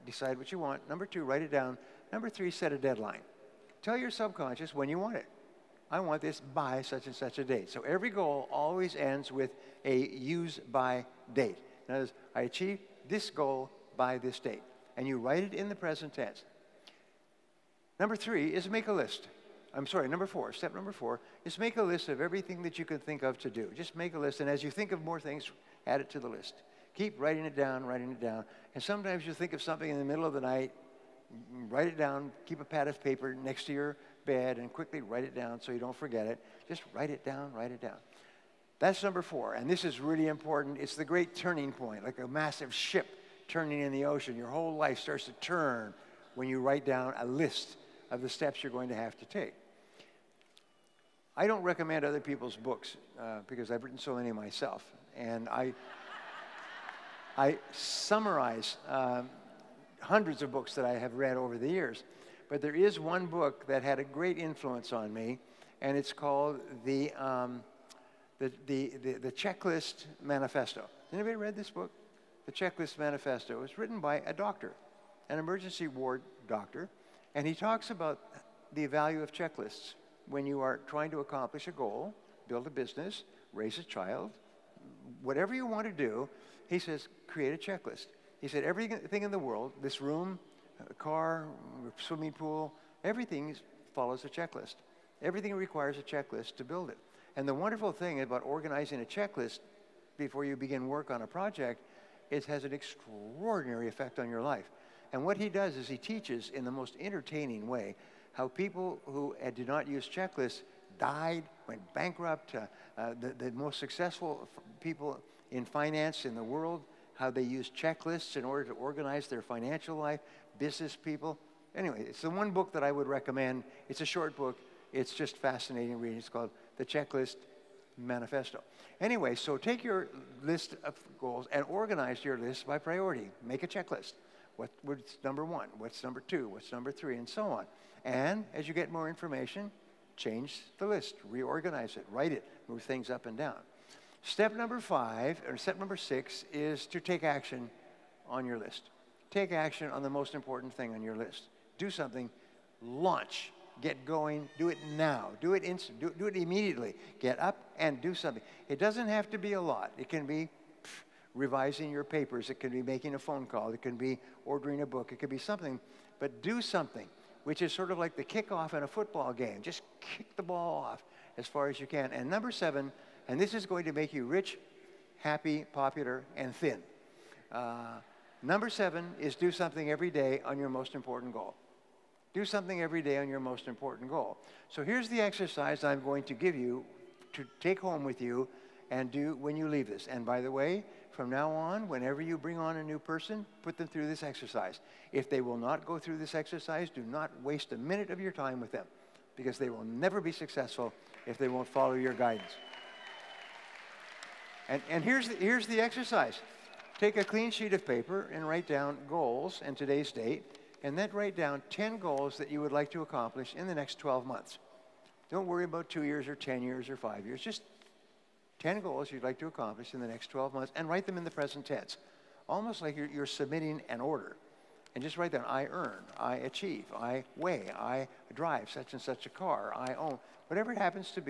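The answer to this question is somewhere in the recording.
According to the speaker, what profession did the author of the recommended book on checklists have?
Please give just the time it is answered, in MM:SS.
01:15.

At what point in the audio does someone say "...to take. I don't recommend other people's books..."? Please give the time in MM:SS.
00:49.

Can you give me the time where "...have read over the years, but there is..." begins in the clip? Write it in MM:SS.
01:00.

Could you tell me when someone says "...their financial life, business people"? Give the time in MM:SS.
01:59.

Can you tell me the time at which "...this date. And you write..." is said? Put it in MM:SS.
00:14.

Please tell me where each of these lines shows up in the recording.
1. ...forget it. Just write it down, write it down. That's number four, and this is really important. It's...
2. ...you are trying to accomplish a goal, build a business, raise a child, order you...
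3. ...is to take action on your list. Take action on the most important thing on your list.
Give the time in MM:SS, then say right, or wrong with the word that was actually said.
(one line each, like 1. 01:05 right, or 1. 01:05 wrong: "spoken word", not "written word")
1. 00:35 right
2. 01:20 wrong: "whatever", not "order"
3. 02:26 right.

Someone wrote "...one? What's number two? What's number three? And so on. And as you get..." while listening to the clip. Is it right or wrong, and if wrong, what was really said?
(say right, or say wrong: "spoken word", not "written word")
right.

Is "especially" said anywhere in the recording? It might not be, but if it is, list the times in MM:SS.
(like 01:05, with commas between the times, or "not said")
not said.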